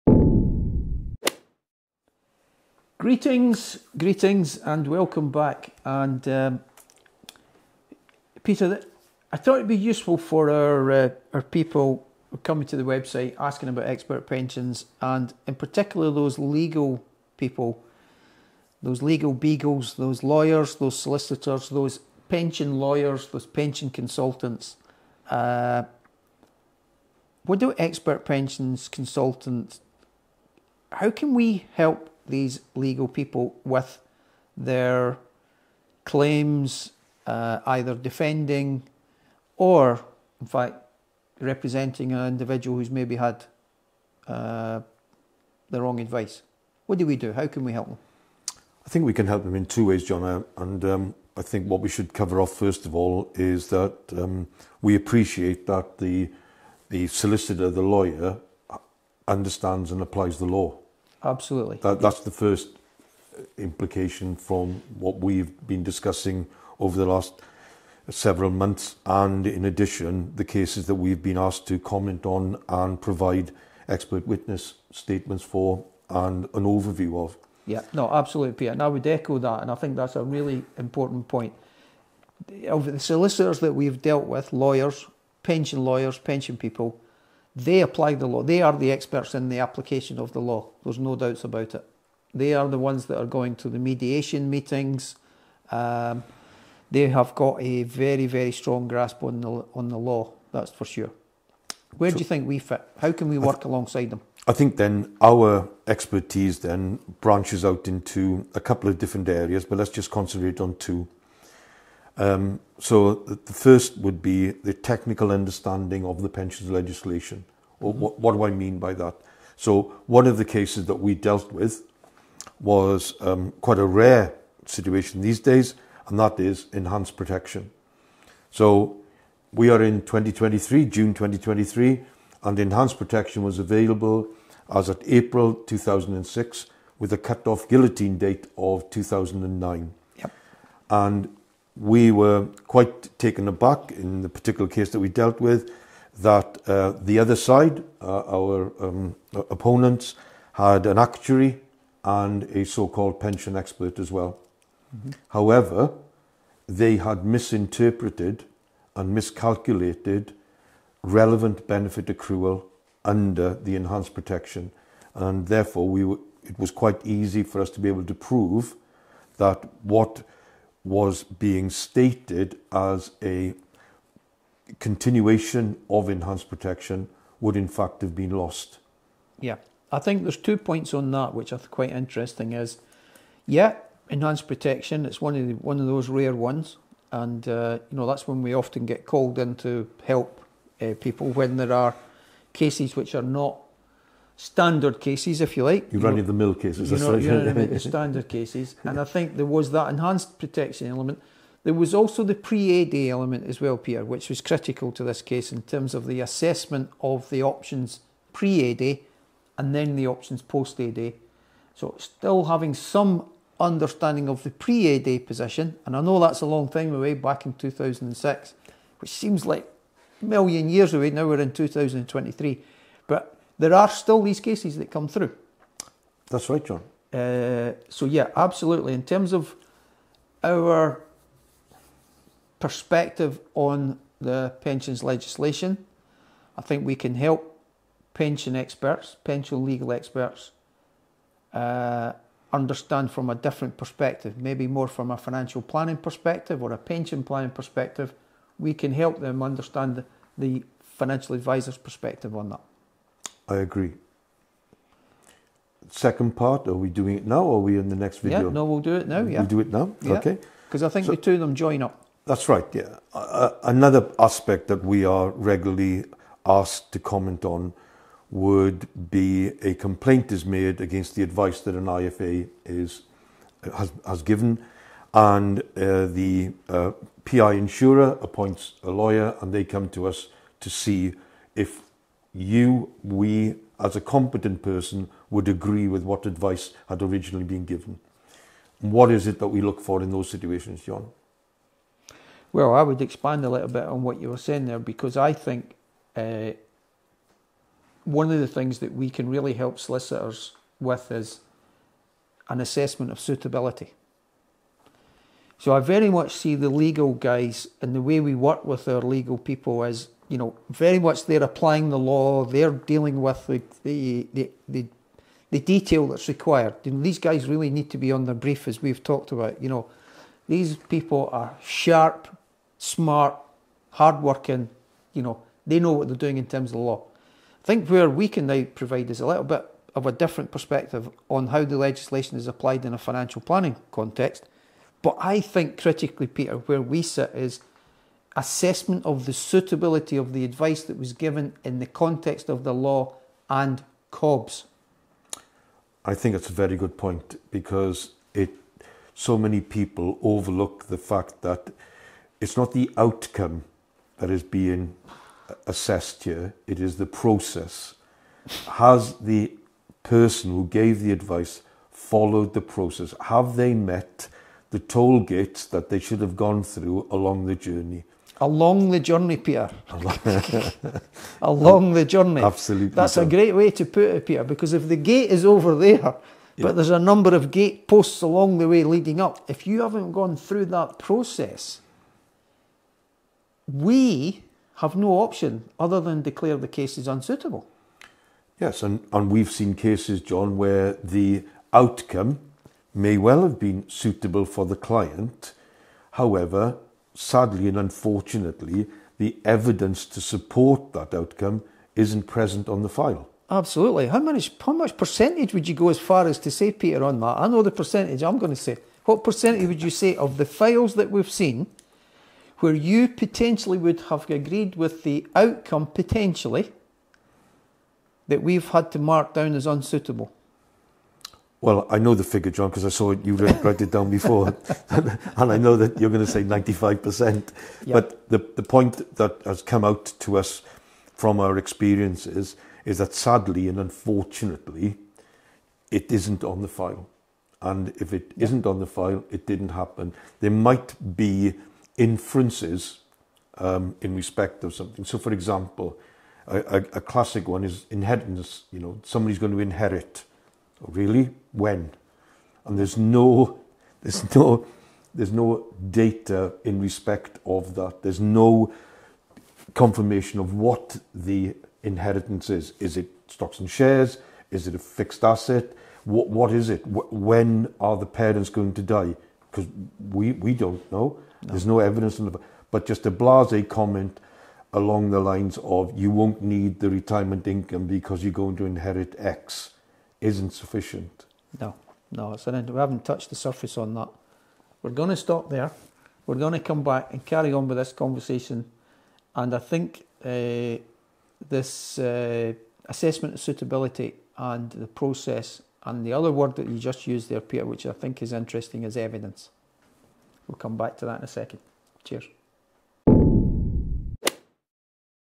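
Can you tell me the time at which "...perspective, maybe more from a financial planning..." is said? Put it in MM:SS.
04:03.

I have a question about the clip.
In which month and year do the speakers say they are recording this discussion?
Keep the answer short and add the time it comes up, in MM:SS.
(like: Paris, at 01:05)
June 2023, at 02:10.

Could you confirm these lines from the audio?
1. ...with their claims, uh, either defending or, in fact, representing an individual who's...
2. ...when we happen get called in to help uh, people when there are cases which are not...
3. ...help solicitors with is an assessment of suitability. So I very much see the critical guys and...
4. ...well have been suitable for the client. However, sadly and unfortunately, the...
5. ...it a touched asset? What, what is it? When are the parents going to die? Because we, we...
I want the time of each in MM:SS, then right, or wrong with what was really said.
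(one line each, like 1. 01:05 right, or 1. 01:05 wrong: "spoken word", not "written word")
1. 00:33 right
2. 03:08 wrong: "often", not "happen"
3. 04:59 wrong: "legal", not "critical"
4. 06:33 right
5. 07:44 wrong: "fixed", not "touched".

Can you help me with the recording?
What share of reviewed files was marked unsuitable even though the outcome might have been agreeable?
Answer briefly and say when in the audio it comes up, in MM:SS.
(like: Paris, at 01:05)
95%, at 07:06.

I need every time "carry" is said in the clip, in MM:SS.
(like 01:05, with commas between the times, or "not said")
08:07.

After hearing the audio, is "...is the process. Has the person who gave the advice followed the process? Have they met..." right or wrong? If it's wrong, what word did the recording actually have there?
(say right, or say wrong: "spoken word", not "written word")
right.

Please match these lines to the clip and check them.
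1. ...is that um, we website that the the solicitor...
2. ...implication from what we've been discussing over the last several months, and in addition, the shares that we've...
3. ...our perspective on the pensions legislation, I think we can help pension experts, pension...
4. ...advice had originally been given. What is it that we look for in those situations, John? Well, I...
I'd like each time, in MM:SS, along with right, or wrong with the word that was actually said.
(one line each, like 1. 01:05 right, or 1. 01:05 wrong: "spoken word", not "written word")
1. 00:53 wrong: "appreciate", not "website"
2. 01:03 wrong: "cases", not "shares"
3. 03:50 right
4. 04:46 right.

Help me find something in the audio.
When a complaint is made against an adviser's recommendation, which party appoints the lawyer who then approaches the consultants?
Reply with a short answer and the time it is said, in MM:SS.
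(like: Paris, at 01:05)
PI insurer, at 04:37.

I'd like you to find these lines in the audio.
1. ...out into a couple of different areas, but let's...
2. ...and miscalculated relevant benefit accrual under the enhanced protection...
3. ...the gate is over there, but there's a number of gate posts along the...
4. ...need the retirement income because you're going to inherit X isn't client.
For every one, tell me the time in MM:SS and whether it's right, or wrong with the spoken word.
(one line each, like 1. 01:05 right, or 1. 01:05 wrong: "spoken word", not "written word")
1. 01:47 right
2. 02:38 right
3. 06:14 right
4. 07:56 wrong: "sufficient", not "client".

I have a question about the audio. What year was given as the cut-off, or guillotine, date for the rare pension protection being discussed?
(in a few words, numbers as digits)
2009.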